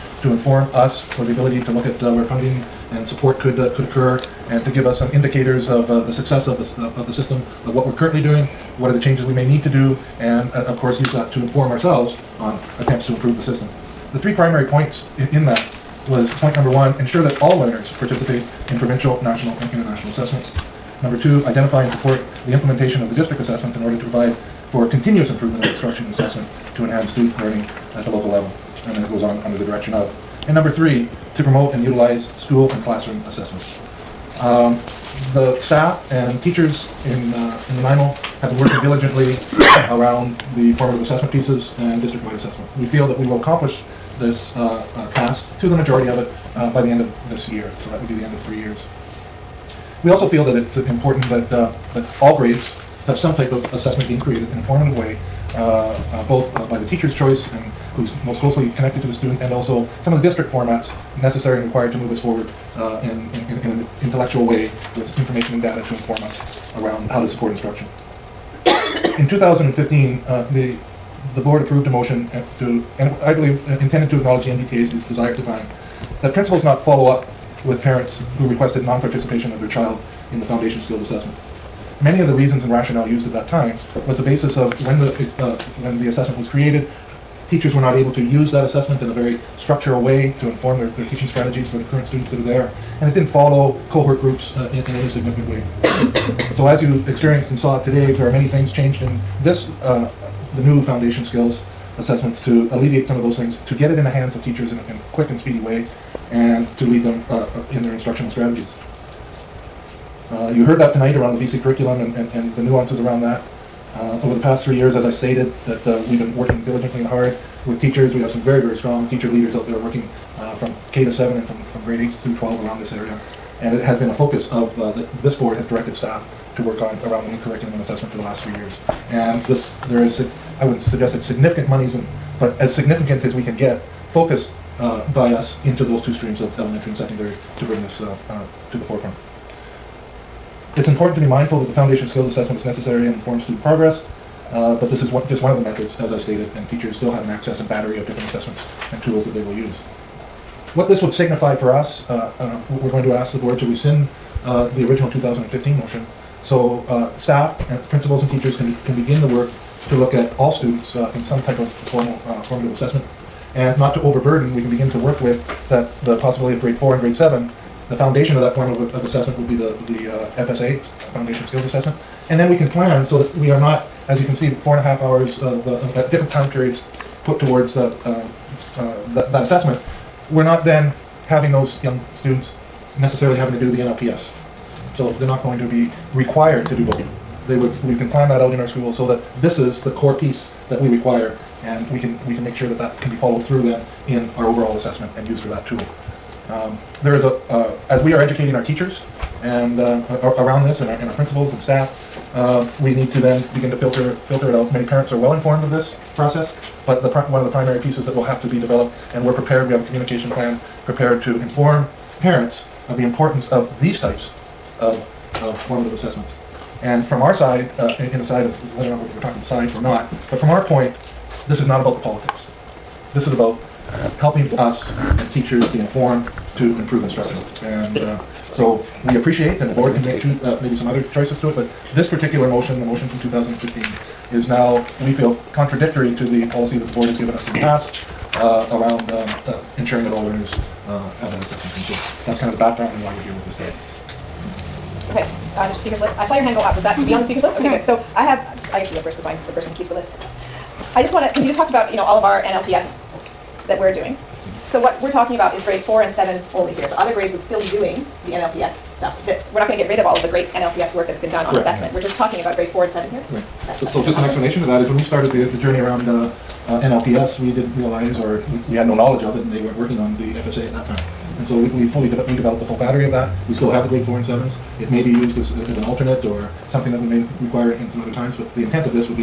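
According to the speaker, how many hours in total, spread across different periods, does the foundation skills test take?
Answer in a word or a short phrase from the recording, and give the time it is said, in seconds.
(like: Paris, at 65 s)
4.5 hours, at 174 s.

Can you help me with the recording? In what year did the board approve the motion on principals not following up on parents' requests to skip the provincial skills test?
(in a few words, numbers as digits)
2015.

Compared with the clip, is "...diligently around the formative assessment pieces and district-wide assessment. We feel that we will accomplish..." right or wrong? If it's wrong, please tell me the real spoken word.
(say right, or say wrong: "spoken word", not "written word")
right.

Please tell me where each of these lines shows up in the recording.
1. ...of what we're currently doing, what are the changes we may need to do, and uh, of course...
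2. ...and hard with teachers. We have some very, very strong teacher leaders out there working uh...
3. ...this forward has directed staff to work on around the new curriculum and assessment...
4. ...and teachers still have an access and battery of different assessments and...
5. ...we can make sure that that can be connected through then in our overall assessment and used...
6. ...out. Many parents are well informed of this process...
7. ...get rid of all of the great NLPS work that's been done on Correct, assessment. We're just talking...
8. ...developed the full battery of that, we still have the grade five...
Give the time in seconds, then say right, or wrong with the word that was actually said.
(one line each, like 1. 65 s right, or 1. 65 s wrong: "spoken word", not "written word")
1. 7 s right
2. 117 s right
3. 125 s wrong: "board", not "forward"
4. 146 s right
5. 192 s wrong: "followed", not "connected"
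6. 204 s right
7. 259 s right
8. 272 s wrong: "four", not "five".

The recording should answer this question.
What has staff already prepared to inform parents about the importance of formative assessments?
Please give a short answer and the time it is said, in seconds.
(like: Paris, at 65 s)
communication plan, at 209 s.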